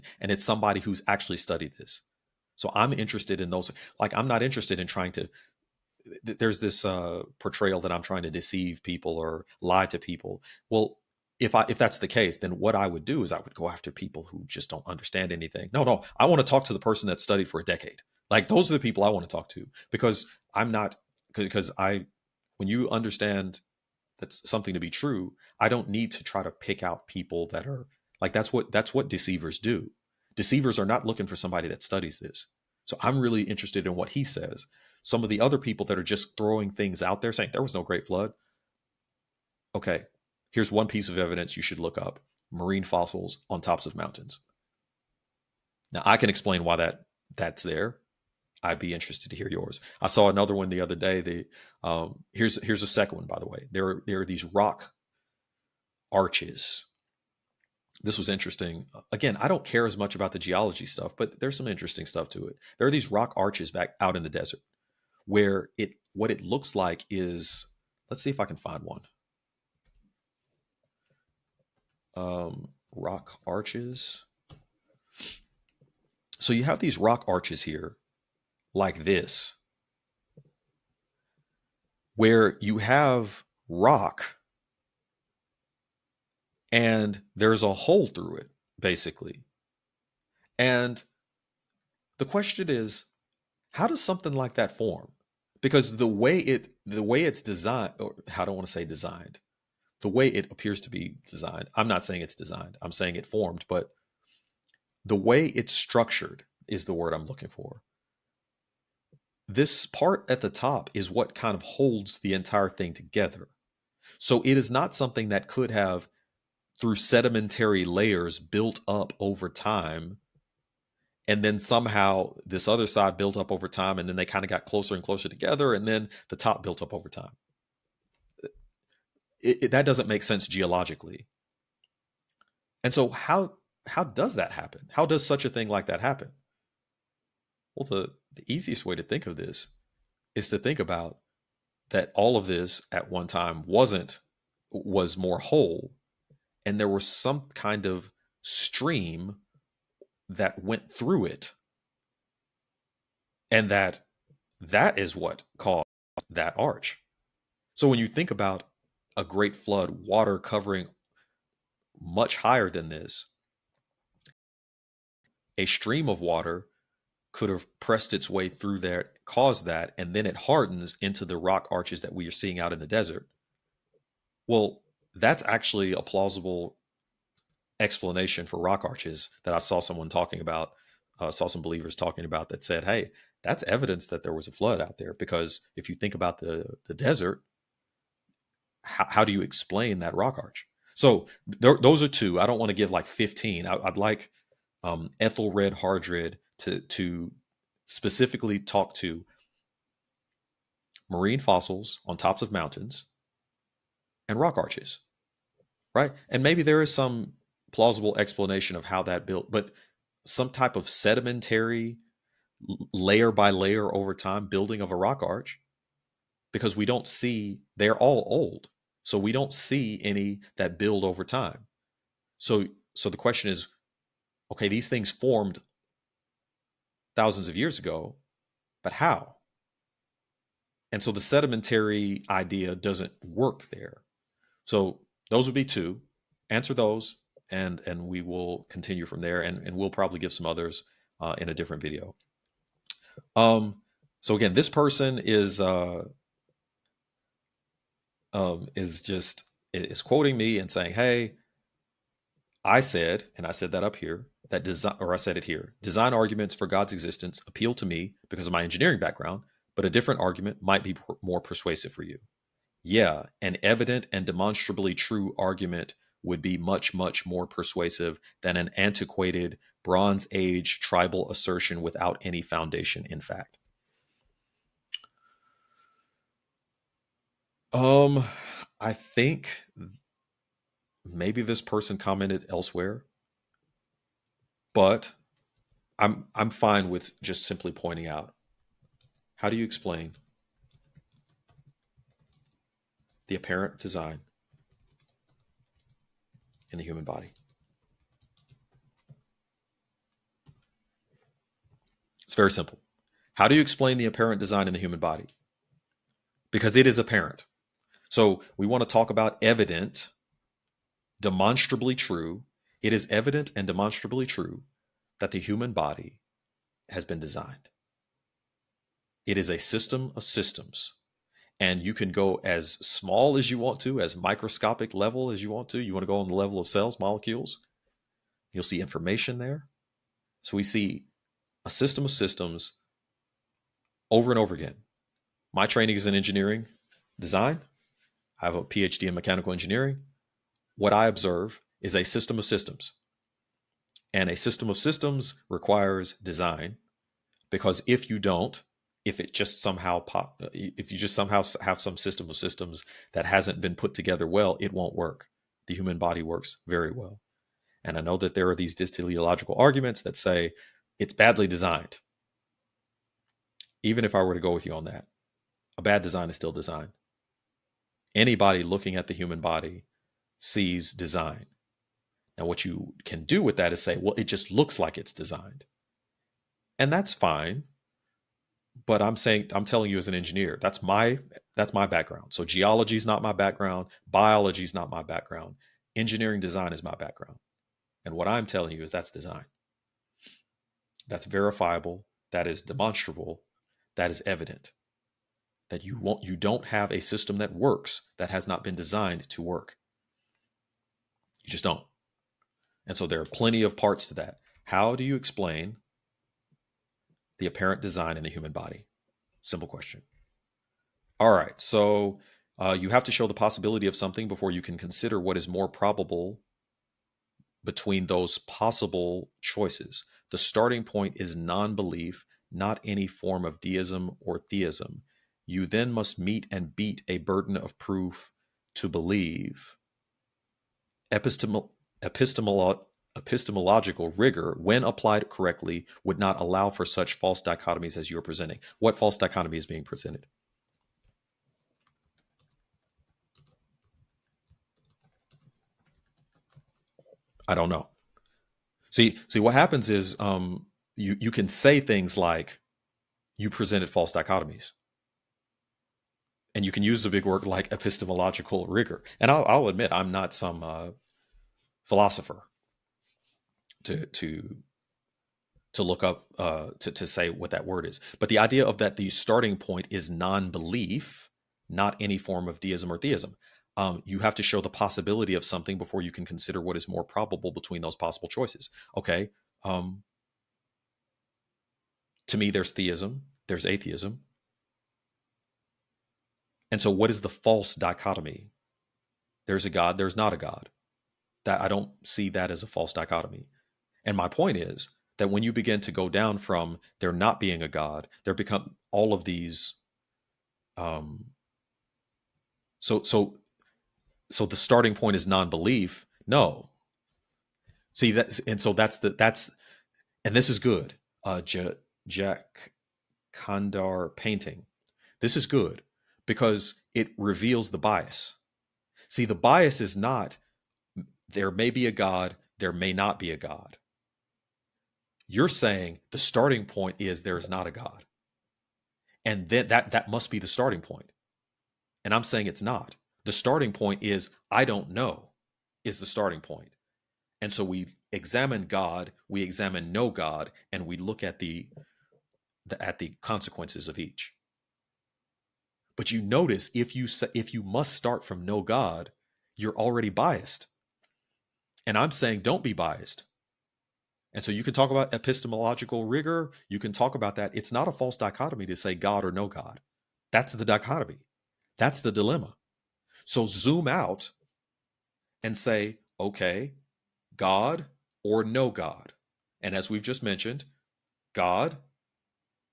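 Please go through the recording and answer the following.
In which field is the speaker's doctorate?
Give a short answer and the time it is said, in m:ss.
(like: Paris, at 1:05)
Mechanical engineering, at 5:39.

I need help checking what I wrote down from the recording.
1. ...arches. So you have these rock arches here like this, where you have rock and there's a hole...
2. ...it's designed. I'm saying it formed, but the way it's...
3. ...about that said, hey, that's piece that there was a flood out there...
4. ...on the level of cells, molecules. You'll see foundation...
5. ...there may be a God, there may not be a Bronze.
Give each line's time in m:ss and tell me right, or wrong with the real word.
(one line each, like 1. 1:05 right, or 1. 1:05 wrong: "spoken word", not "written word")
1. 1:13 right
2. 1:42 right
3. 3:02 wrong: "evidence", not "piece"
4. 5:26 wrong: "information", not "foundation"
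5. 8:41 wrong: "God", not "Bronze".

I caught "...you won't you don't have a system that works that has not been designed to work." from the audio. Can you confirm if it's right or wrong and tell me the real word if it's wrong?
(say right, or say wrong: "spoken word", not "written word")
right.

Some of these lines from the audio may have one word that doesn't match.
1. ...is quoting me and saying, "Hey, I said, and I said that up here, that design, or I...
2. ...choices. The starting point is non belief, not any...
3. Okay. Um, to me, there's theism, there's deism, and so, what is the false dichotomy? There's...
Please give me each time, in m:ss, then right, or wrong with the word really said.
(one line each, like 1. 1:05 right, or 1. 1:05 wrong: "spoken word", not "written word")
1. 4:09 right
2. 6:59 right
3. 7:58 wrong: "atheism", not "deism".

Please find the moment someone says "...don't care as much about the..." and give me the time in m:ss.
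0:59.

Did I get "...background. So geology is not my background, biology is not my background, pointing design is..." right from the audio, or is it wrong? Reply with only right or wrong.
wrong.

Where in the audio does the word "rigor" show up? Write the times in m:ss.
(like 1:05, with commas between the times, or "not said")
7:14, 7:38, 9:16.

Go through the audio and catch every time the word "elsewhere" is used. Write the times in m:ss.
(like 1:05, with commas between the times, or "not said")
4:42.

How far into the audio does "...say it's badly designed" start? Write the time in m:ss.
6:00.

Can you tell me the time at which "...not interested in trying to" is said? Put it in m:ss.
0:04.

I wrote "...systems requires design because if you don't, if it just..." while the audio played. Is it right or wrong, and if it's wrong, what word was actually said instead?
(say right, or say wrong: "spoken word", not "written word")
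right.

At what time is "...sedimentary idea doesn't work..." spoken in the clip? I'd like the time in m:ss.
3:51.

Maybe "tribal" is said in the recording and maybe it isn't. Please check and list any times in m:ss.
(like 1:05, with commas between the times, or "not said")
4:30.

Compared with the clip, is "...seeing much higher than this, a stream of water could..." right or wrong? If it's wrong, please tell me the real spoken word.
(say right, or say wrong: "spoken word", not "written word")
wrong: "covering", not "seeing".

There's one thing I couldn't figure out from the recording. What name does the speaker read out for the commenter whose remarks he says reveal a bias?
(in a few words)
Jack Kandar.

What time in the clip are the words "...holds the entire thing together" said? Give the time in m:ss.
1:51.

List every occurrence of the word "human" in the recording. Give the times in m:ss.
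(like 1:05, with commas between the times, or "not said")
4:56, 5:04, 5:15, 5:55, 6:09, 6:48.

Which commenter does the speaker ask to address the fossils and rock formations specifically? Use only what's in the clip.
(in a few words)
Ethelred Hardred.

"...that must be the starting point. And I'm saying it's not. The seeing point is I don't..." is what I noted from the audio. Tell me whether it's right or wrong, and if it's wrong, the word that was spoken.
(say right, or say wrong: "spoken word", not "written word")
wrong: "starting", not "seeing".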